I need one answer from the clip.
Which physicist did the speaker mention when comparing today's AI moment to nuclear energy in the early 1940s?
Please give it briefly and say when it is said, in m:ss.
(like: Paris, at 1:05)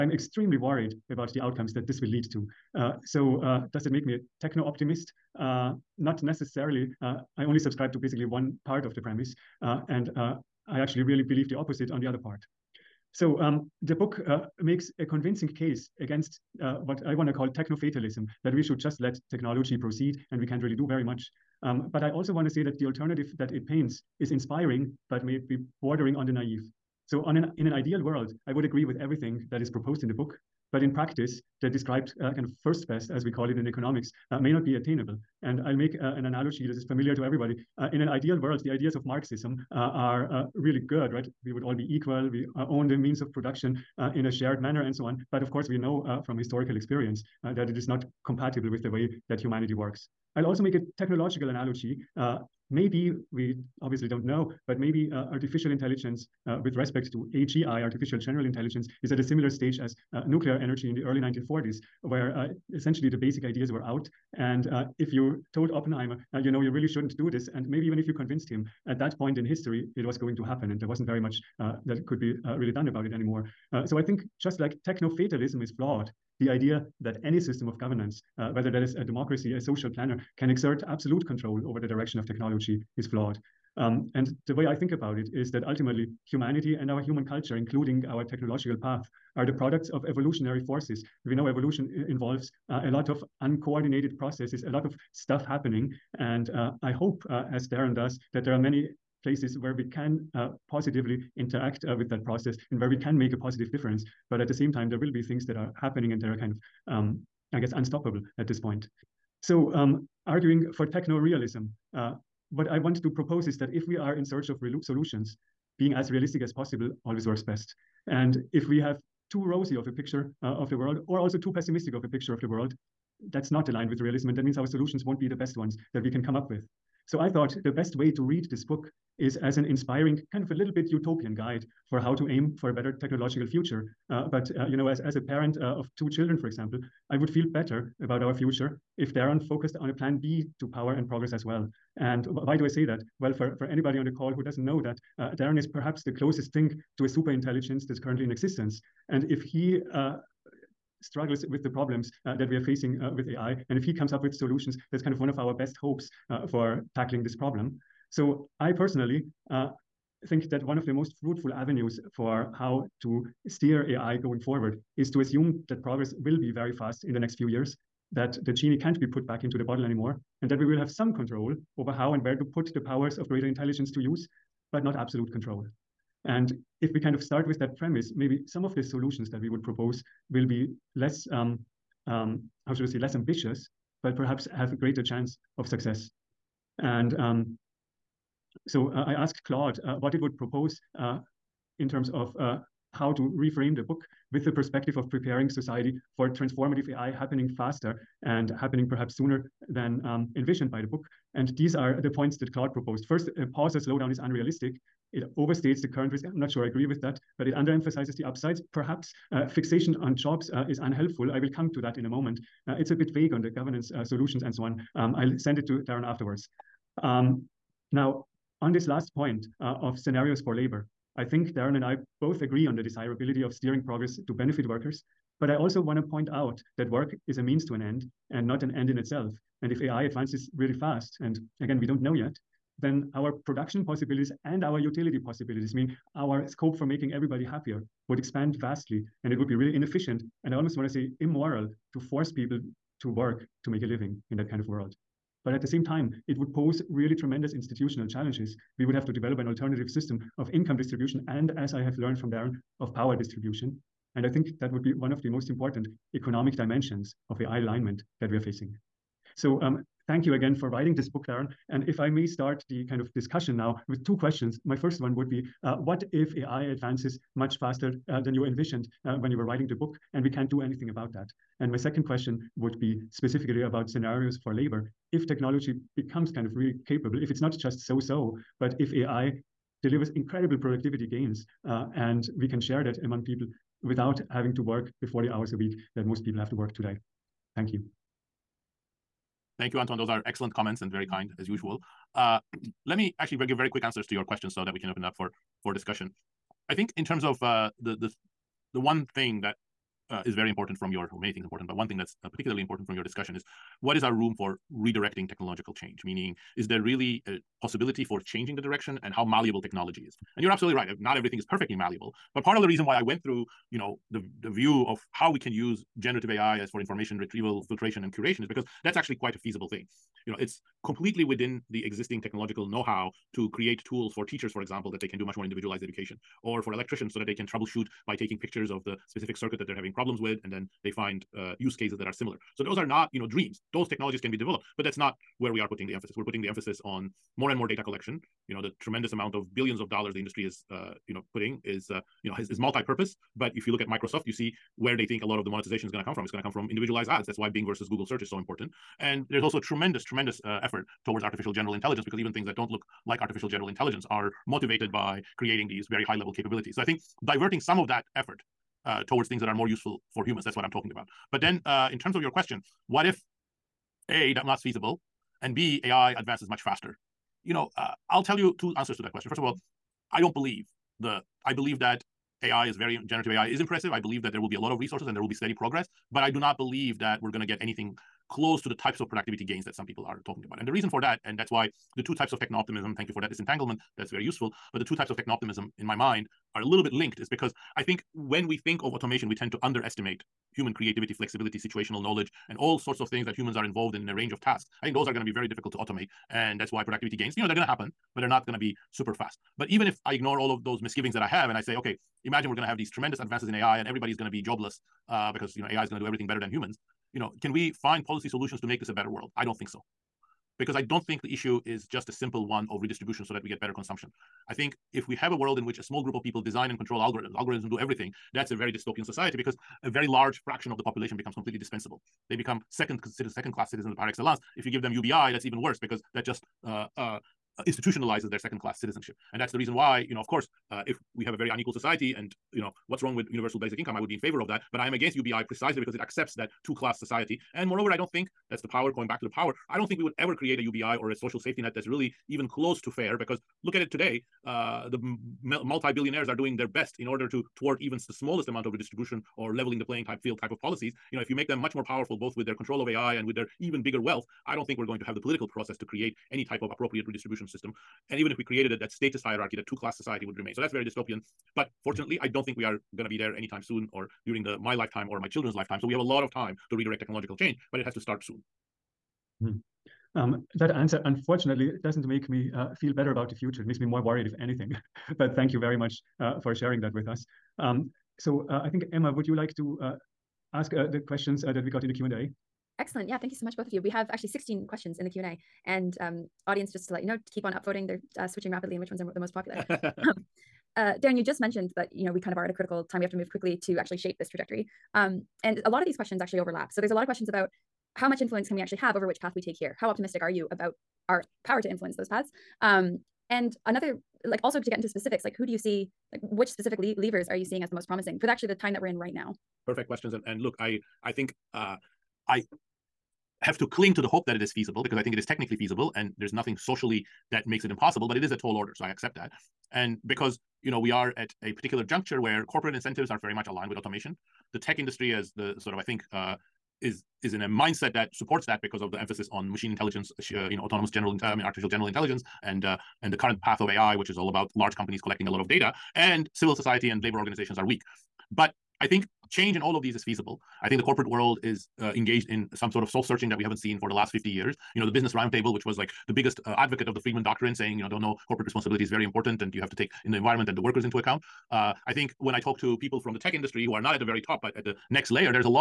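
Oppenheimer, at 1:05.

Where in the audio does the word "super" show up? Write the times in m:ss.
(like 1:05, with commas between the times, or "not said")
2:27, 6:38.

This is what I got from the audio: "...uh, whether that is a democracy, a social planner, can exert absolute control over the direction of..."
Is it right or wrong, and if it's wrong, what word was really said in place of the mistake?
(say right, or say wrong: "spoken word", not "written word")
right.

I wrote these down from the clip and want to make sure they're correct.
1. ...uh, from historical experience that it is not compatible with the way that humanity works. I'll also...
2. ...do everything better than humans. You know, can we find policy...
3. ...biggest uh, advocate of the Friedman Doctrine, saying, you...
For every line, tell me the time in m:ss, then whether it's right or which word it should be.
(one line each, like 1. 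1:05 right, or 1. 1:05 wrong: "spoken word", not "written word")
1. 0:46 right
2. 6:45 right
3. 9:06 right.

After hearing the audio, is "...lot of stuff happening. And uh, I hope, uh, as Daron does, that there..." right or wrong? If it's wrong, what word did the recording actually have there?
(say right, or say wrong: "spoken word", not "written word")
right.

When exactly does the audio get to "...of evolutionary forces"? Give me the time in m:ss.
1:29.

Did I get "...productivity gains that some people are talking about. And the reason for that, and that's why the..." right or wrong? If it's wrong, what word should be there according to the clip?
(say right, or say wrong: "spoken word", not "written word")
right.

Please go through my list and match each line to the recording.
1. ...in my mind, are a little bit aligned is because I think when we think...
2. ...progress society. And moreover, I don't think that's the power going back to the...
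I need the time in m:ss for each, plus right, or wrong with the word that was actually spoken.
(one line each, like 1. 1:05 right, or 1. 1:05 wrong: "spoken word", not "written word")
1. 6:25 wrong: "linked", not "aligned"
2. 7:16 wrong: "class", not "progress".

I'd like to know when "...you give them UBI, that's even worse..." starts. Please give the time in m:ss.
7:04.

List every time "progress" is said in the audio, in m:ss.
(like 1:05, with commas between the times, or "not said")
2:21, 2:45, 3:43, 6:15.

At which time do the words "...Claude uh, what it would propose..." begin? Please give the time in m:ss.
3:09.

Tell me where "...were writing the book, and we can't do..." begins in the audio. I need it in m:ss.
4:29.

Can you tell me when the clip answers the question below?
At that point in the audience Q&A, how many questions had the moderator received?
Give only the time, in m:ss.
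8:04.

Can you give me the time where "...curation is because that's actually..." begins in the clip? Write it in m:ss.
5:18.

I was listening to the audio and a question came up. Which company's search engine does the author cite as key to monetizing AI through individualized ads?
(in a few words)
Bing.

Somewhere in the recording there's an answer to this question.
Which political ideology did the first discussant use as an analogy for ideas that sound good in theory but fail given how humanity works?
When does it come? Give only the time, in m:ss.
0:39.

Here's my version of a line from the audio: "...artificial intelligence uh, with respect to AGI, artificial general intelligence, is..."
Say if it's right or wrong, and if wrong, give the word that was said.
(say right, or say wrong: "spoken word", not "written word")
right.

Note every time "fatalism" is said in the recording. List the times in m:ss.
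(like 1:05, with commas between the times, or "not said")
0:17, 1:15.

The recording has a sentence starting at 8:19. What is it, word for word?
How optimistic are you about our power to influence those paths?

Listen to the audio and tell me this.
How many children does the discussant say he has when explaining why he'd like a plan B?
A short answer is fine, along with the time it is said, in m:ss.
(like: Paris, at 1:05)
2, at 2:15.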